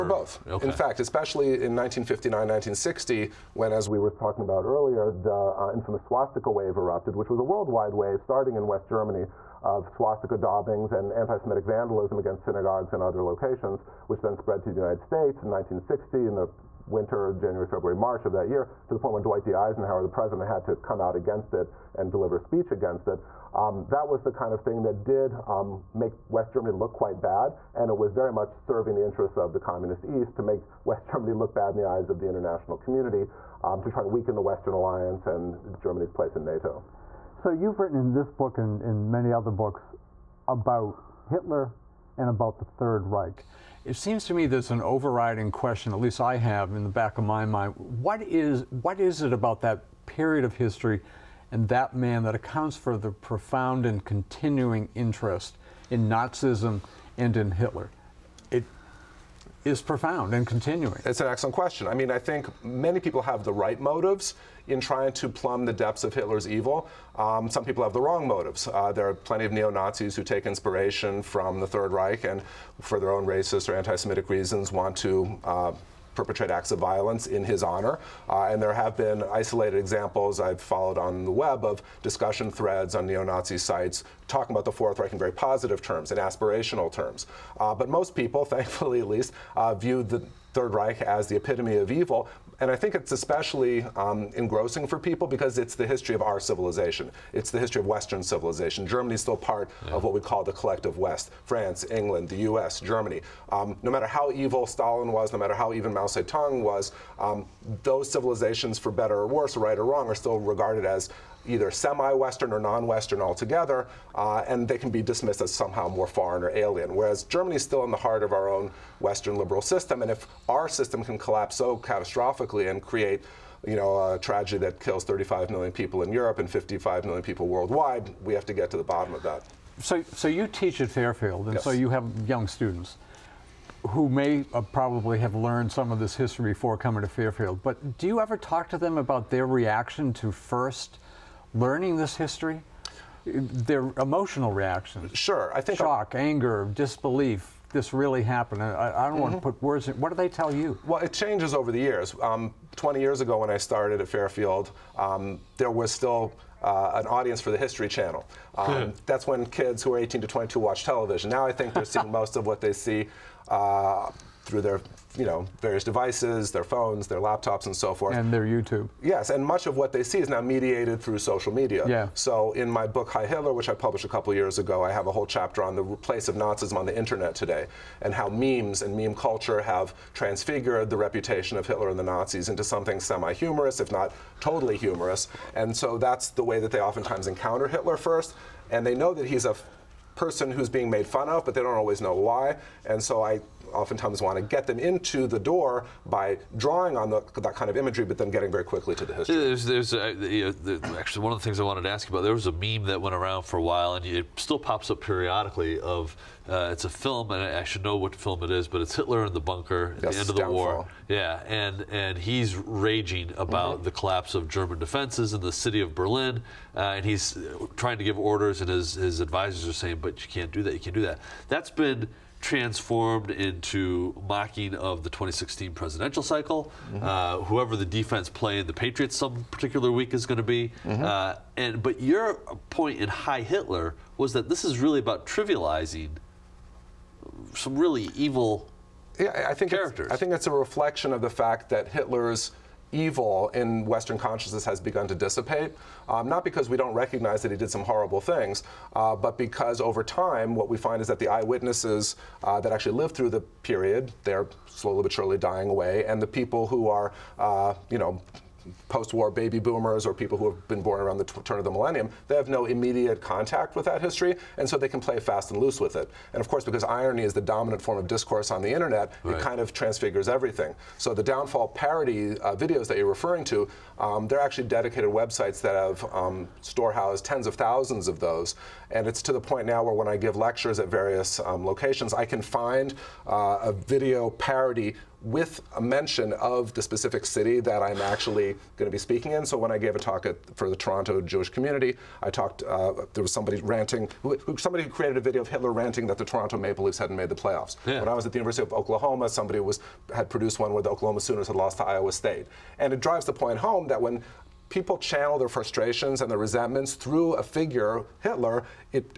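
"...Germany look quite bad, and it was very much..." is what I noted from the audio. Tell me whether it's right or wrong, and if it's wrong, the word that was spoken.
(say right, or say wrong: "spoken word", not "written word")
right.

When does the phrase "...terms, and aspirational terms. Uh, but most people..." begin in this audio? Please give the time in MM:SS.
01:25.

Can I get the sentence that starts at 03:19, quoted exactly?
There's, there's uh, you know, the, actually one of the things I wanted to ask you about.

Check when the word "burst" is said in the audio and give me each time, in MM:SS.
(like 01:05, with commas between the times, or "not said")
not said.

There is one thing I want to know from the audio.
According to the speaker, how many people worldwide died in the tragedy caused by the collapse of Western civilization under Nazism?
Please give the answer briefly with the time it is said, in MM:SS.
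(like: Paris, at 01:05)
55 million, at 02:06.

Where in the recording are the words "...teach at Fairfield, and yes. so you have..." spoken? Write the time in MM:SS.
02:10.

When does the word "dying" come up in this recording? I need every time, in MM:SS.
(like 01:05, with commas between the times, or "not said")
04:15.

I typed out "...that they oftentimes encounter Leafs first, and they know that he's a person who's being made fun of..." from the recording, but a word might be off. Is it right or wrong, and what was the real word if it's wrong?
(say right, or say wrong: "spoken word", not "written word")
wrong: "Hitler", not "Leafs".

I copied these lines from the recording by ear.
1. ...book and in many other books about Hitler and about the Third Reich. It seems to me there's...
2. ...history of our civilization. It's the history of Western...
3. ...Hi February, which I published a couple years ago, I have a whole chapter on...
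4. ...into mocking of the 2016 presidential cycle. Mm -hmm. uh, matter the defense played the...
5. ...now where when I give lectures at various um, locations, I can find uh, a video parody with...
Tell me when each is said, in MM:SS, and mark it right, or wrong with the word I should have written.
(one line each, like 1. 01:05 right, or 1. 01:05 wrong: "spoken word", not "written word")
1. 00:38 right
2. 01:35 right
3. 02:53 wrong: "Hitler", not "February"
4. 03:43 wrong: "whoever", not "matter"
5. 04:39 right.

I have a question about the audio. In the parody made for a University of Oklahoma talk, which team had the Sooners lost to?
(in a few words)
Iowa State.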